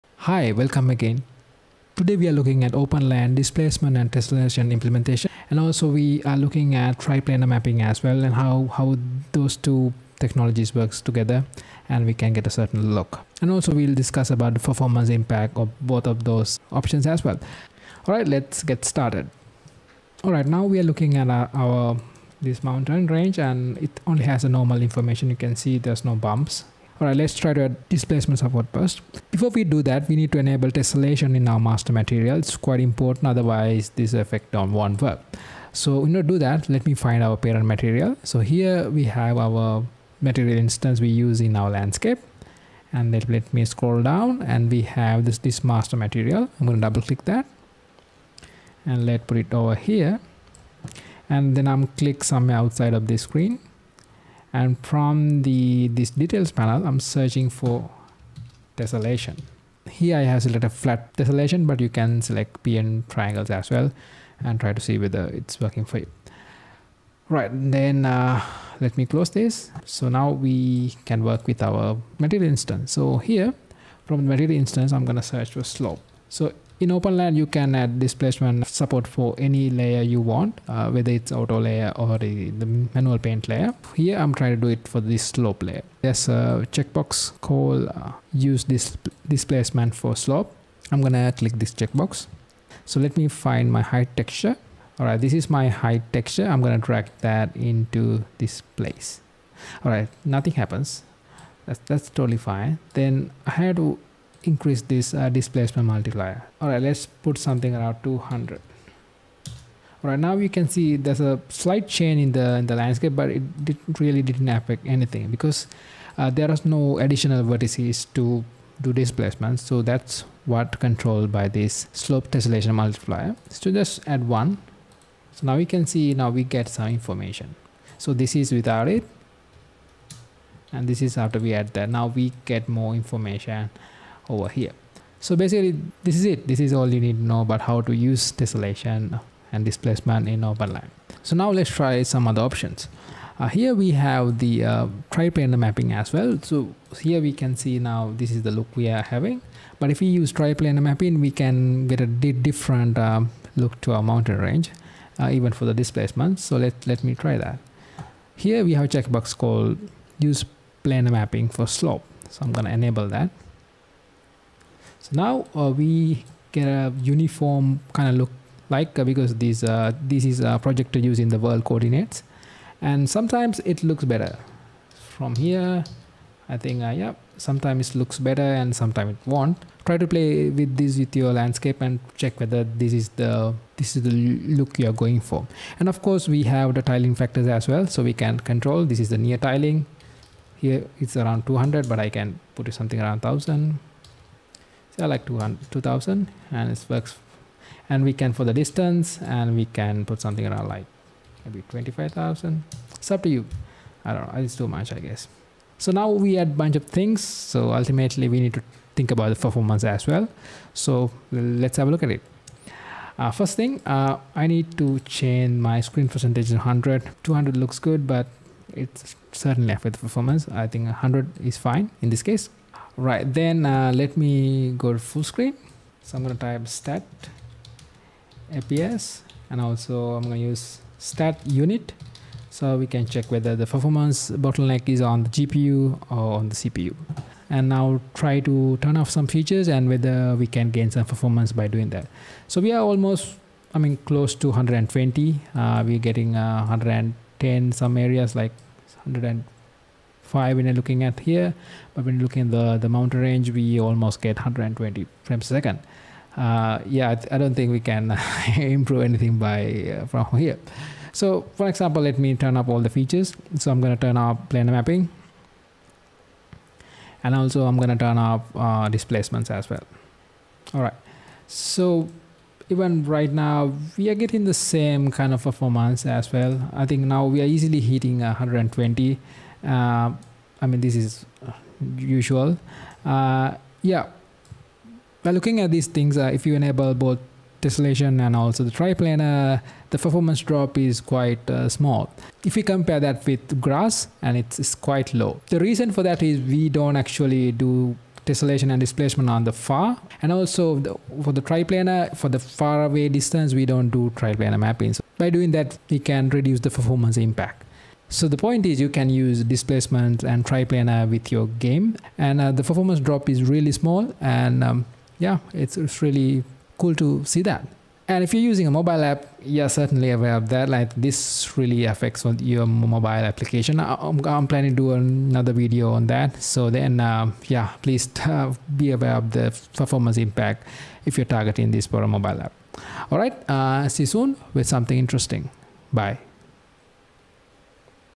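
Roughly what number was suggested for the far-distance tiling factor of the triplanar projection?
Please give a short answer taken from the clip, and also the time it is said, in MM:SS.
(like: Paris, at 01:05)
25,000, at 03:21.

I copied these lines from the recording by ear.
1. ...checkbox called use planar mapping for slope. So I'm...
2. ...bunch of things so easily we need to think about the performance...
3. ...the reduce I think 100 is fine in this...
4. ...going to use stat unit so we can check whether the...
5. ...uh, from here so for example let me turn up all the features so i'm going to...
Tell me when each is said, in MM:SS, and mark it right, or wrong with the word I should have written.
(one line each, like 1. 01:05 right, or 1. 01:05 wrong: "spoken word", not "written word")
1. 02:38 right
2. 03:26 wrong: "ultimately", not "easily"
3. 03:39 wrong: "performance", not "reduce"
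4. 03:50 right
5. 04:19 right.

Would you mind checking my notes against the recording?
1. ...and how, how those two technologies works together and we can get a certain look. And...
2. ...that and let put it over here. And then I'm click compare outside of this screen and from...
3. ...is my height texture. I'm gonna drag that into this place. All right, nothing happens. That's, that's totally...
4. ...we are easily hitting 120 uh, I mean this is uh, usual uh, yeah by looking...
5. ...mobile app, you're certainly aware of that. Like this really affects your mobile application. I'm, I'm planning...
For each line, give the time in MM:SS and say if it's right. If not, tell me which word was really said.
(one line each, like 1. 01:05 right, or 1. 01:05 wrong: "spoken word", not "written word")
1. 00:08 right
2. 00:47 wrong: "somewhere", not "compare"
3. 01:35 right
4. 04:37 right
5. 05:18 right.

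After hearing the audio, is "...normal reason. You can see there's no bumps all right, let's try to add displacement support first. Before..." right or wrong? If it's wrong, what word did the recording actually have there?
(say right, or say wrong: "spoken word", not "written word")
wrong: "information", not "reason".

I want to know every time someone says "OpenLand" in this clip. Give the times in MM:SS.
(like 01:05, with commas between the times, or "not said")
00:02, 01:16, 02:20.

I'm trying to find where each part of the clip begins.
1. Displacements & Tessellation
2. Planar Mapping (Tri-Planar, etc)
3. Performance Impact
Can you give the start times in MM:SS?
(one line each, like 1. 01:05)
1. 00:19
2. 02:21
3. 03:25.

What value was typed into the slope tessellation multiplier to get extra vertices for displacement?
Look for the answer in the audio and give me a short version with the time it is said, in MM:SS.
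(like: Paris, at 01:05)
1, at 02:03.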